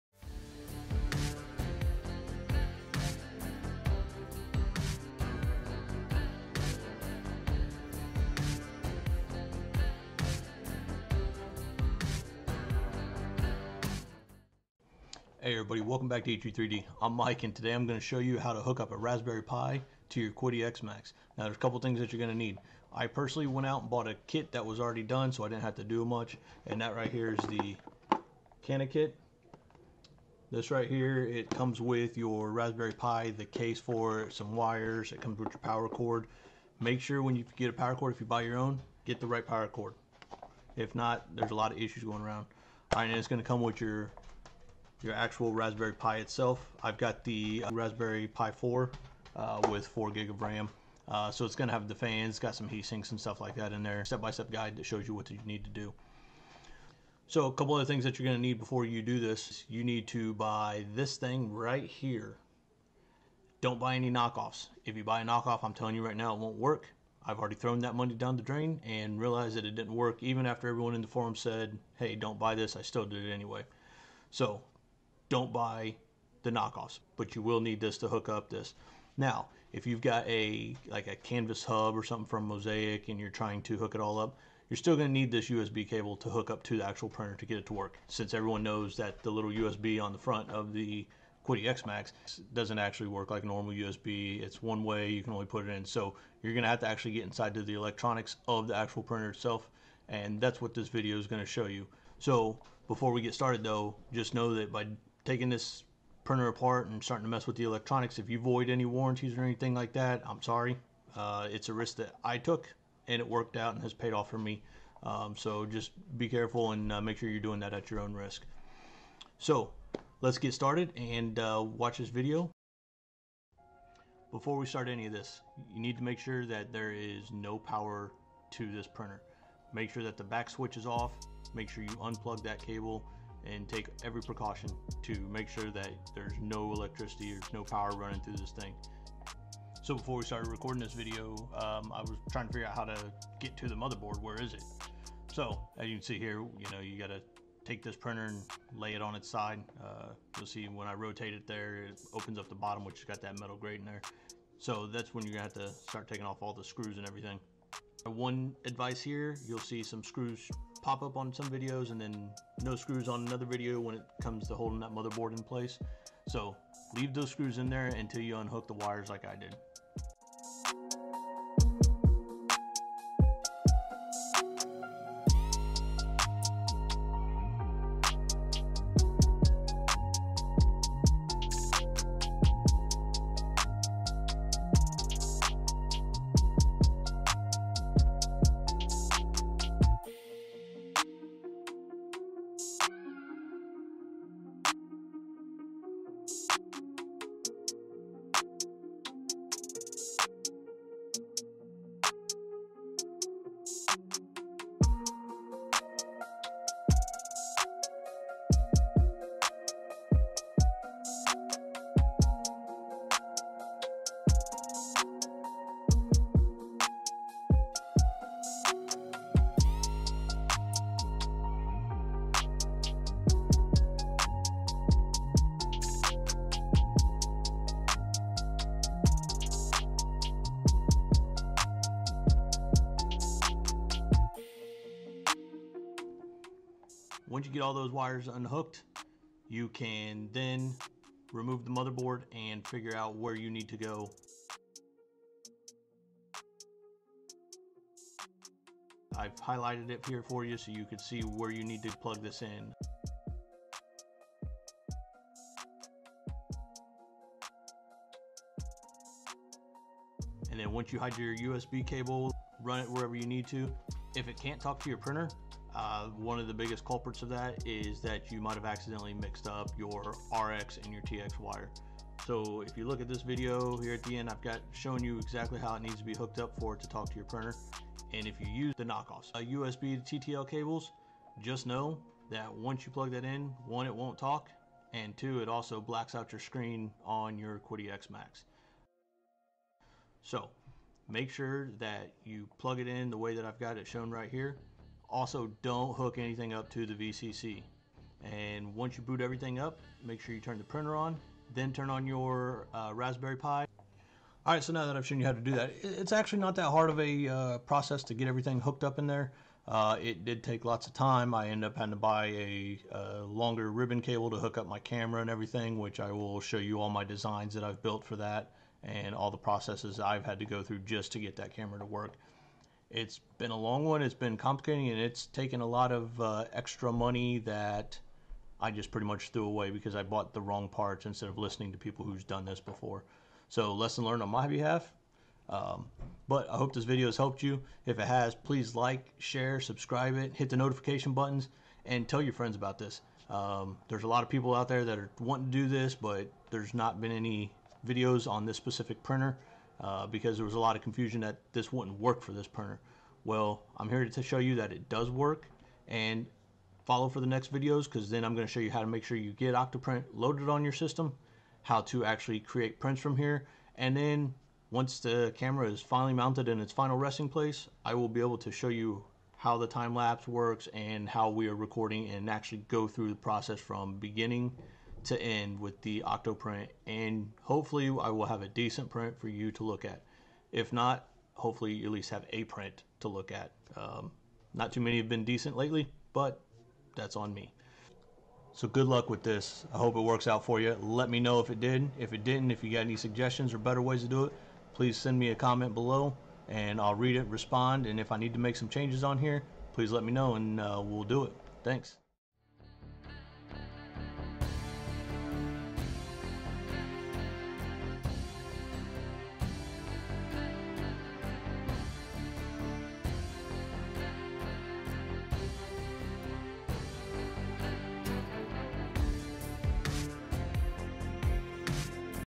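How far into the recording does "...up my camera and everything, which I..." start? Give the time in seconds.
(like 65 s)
314 s.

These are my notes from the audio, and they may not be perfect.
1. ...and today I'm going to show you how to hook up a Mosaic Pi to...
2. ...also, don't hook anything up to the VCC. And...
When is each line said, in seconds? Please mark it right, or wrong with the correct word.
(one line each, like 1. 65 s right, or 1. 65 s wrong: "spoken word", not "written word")
1. 17 s wrong: "Raspberry", not "Mosaic"
2. 295 s right.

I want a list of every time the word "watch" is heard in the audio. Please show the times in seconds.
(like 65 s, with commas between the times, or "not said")
121 s.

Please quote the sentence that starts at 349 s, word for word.
Uh, because there was a lot of confusion that this wouldn't work for this printer.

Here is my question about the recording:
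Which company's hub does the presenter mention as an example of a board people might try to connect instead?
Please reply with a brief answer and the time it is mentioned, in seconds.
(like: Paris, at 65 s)
Mosaic, at 82 s.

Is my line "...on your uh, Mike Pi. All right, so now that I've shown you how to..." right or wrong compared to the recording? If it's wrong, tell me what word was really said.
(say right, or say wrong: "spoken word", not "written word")
wrong: "Raspberry", not "Mike".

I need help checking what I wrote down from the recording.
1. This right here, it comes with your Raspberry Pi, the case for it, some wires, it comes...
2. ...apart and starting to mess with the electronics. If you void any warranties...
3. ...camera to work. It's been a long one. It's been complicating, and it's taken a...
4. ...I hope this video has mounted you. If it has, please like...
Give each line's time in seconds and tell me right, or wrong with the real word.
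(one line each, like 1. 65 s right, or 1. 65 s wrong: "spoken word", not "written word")
1. 30 s right
2. 106 s right
3. 321 s right
4. 336 s wrong: "helped", not "mounted".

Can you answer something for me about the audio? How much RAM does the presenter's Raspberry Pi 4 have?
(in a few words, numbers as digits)
4 gig.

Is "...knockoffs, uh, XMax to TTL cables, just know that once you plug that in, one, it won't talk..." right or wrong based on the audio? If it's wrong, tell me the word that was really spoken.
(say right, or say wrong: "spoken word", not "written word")
wrong: "USB", not "XMax".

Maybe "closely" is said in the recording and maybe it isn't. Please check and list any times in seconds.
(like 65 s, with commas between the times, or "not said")
not said.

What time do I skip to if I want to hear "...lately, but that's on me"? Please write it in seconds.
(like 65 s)
385 s.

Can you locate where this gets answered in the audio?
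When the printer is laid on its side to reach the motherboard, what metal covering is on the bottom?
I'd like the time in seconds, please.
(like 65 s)
153 s.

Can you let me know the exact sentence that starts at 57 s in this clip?
So a couple other things that you're going to need before you do this.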